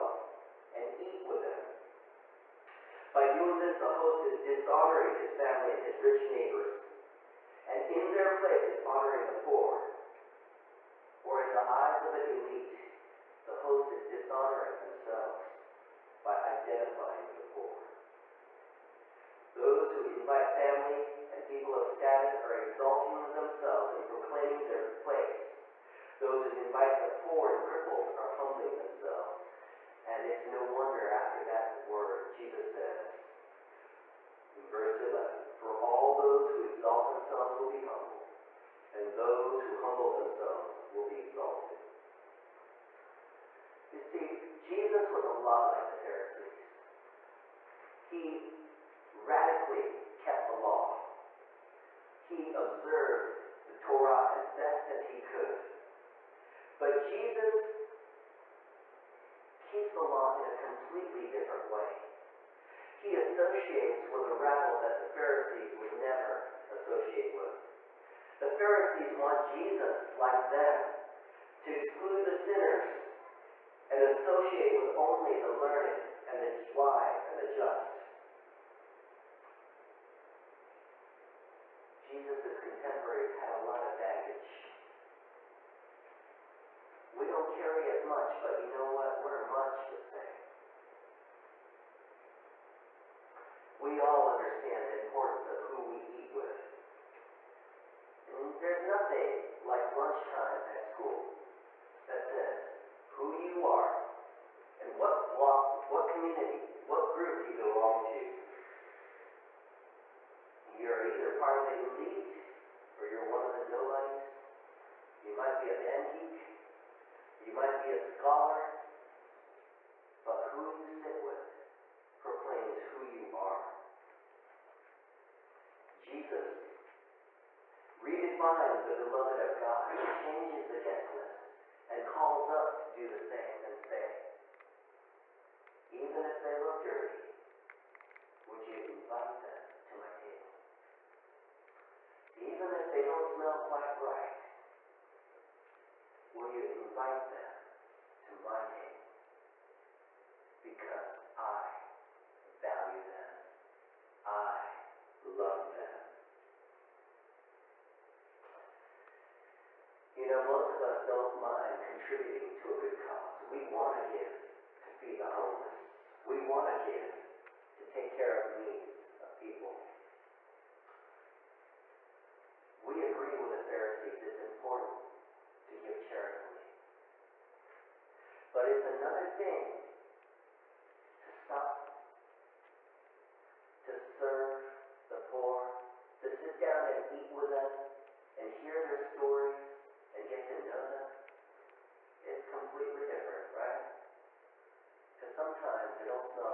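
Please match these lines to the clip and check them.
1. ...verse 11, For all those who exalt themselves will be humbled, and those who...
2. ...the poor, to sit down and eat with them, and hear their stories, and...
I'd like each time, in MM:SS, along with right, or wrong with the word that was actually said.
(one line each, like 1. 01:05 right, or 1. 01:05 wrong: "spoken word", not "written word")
1. 00:34 right
2. 03:05 right.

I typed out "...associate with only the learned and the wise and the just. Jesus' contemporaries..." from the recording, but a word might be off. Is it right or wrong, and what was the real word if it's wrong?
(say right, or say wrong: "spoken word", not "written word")
right.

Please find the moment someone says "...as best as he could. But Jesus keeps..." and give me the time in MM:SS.
00:54.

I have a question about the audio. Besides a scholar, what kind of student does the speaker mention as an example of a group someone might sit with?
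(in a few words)
Band geek.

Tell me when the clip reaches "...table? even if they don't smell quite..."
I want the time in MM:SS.
02:20.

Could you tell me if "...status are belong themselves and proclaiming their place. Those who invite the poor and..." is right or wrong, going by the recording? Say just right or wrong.
wrong.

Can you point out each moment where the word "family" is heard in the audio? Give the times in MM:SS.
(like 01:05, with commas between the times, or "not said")
00:05, 00:20.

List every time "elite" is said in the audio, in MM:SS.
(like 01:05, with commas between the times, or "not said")
00:12, 01:51.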